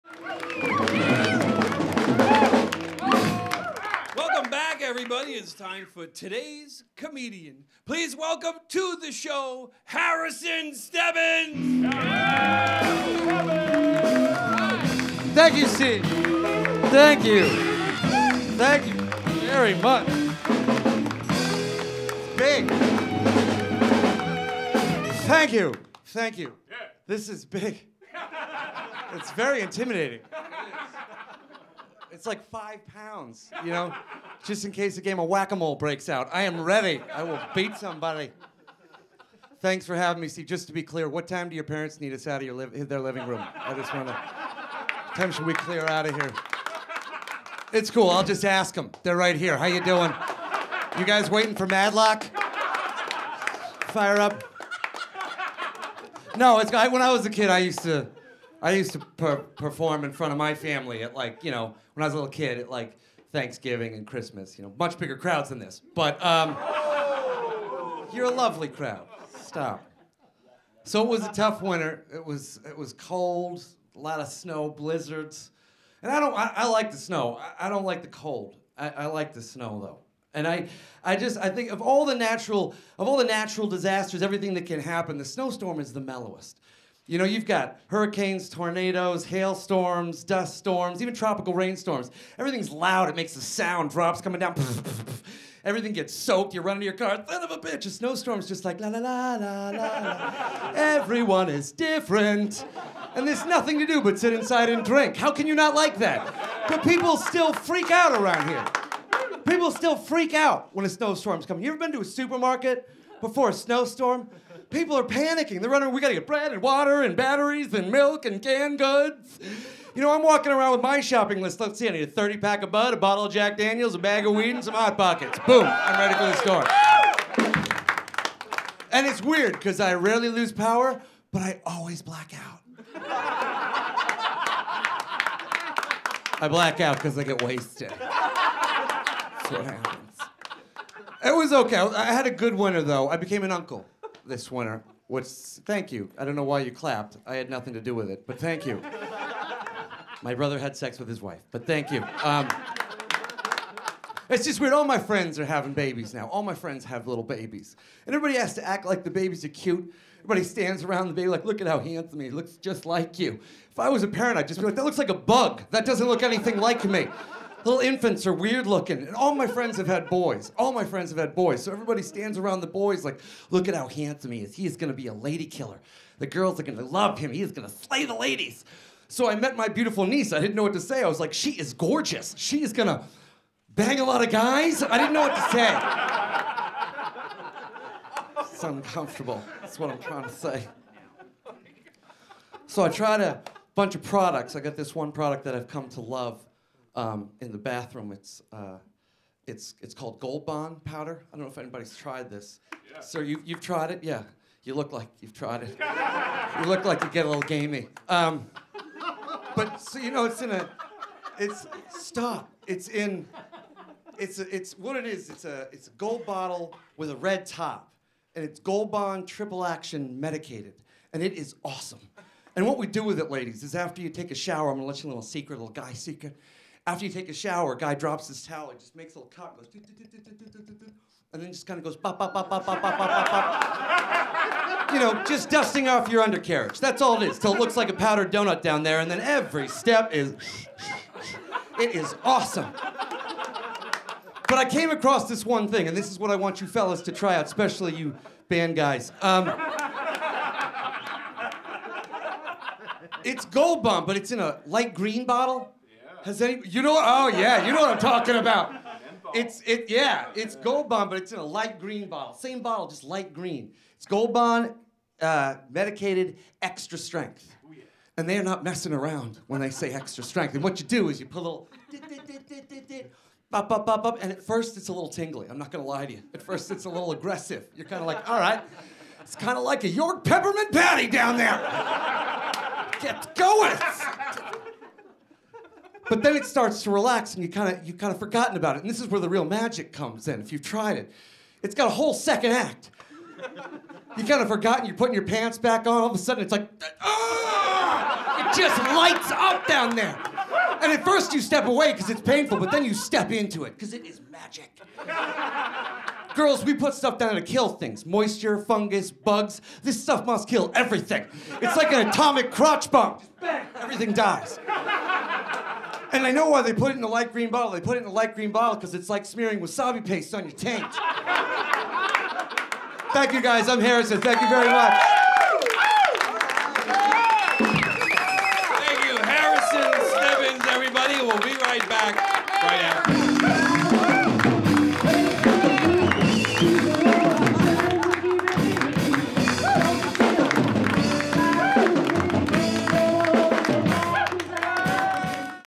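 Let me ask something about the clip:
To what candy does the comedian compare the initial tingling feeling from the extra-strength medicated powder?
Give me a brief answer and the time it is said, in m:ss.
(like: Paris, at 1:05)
York peppermint patty, at 4:39.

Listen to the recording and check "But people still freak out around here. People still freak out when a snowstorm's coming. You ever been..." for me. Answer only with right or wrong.
right.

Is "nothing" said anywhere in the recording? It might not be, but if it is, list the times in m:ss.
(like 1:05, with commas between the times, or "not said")
1:43, 2:27.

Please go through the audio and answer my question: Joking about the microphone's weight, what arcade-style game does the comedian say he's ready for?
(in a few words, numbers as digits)
whack a mole.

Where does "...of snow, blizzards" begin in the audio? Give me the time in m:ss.
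1:14.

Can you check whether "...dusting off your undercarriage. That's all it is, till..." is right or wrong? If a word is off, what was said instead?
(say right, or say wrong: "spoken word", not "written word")
right.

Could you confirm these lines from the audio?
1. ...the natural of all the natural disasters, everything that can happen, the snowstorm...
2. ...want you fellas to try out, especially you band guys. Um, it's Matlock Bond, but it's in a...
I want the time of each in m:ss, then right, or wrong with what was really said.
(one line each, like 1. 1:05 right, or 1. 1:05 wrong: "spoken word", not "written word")
1. 1:22 right
2. 4:06 wrong: "Gold", not "Matlock".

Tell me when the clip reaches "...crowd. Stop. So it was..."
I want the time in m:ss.
1:08.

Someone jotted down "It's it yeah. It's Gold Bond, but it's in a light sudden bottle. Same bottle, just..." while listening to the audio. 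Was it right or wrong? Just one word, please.
wrong.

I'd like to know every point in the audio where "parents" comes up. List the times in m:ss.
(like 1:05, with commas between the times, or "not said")
0:41, 2:44.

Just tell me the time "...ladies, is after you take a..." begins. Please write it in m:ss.
3:43.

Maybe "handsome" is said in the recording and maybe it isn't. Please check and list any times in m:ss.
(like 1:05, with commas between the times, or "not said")
2:41, 2:53.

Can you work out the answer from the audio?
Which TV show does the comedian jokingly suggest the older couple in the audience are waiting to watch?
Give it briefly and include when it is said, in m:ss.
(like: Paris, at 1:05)
Matlock, at 0:51.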